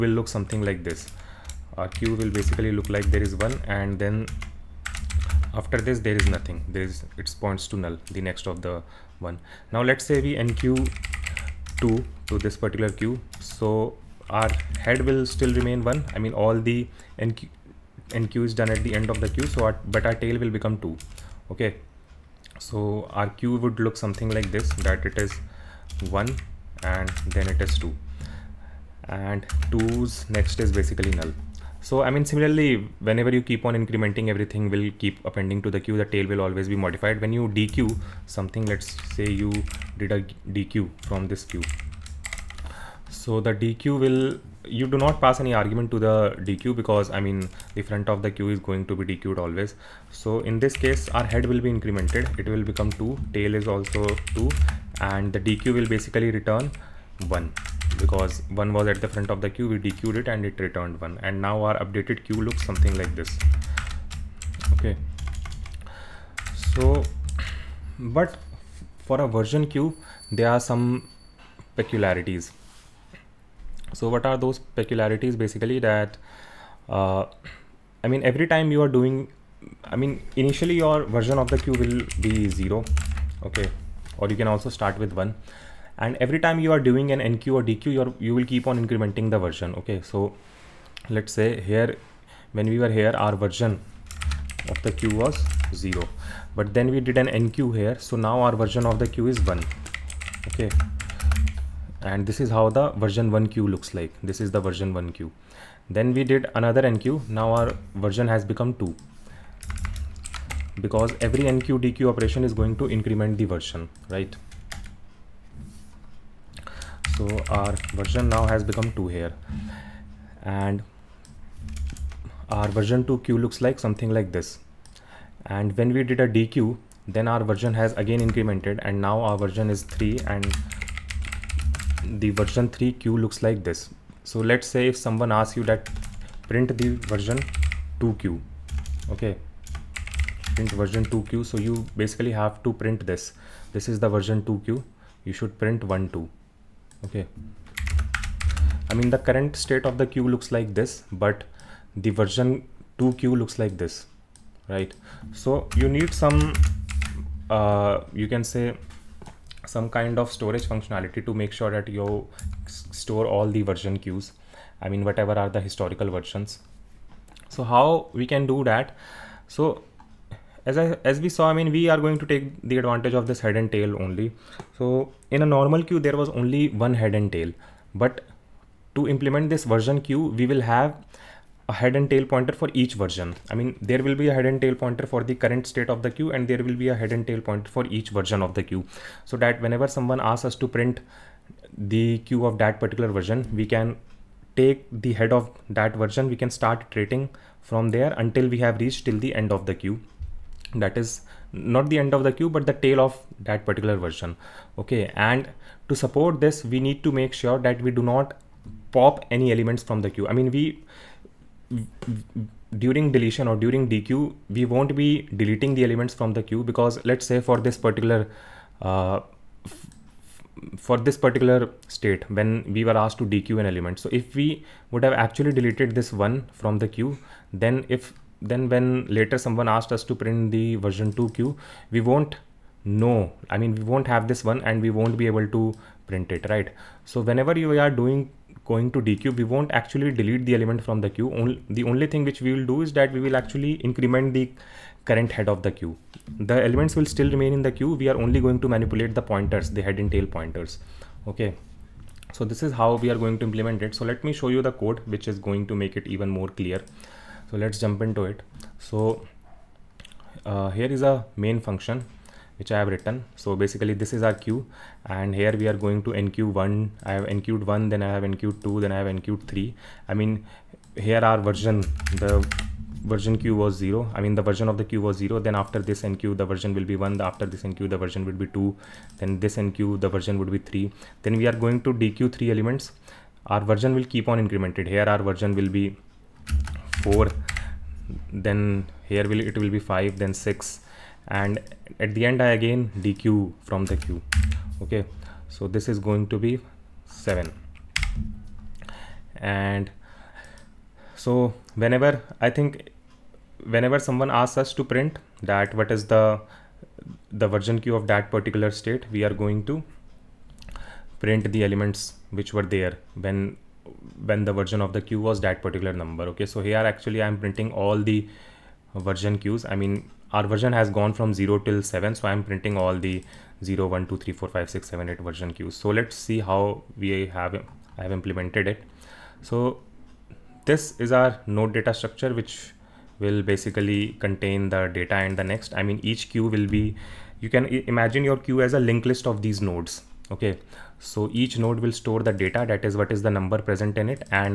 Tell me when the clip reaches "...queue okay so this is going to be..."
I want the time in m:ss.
4:53.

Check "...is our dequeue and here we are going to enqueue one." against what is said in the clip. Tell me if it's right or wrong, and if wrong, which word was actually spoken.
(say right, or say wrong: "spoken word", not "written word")
wrong: "queue", not "dequeue".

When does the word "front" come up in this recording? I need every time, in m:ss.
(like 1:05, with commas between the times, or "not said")
0:47, 0:59.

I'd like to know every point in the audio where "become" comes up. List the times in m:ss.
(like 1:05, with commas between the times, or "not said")
0:20, 0:52, 1:48, 1:58.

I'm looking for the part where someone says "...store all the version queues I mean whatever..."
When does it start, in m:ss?
2:43.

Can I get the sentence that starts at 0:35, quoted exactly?
The tail will always be modified.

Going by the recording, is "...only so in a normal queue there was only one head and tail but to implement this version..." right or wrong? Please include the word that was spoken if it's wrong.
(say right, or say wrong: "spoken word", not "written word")
right.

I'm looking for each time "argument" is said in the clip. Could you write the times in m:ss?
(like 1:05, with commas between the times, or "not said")
0:45.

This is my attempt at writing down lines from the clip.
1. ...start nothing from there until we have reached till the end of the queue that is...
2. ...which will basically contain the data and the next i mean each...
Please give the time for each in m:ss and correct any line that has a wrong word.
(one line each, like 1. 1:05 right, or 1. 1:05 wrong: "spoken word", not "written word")
1. 3:16 wrong: "iterating", not "nothing"
2. 5:32 right.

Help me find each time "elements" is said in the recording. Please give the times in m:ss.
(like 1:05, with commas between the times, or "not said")
3:29, 3:35, 3:43, 4:00, 4:06, 4:42, 5:11.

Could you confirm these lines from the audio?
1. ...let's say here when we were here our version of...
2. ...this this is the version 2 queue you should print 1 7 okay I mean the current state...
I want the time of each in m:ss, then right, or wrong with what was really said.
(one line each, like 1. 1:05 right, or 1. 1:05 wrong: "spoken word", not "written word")
1. 1:31 right
2. 2:23 wrong: "2", not "7".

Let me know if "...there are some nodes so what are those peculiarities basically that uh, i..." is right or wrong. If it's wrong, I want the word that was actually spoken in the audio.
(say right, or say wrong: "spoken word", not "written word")
wrong: "peculiarities", not "nodes".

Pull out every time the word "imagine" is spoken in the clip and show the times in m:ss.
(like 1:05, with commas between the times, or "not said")
5:37.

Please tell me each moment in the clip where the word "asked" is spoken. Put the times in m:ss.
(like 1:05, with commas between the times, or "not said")
3:42, 3:49.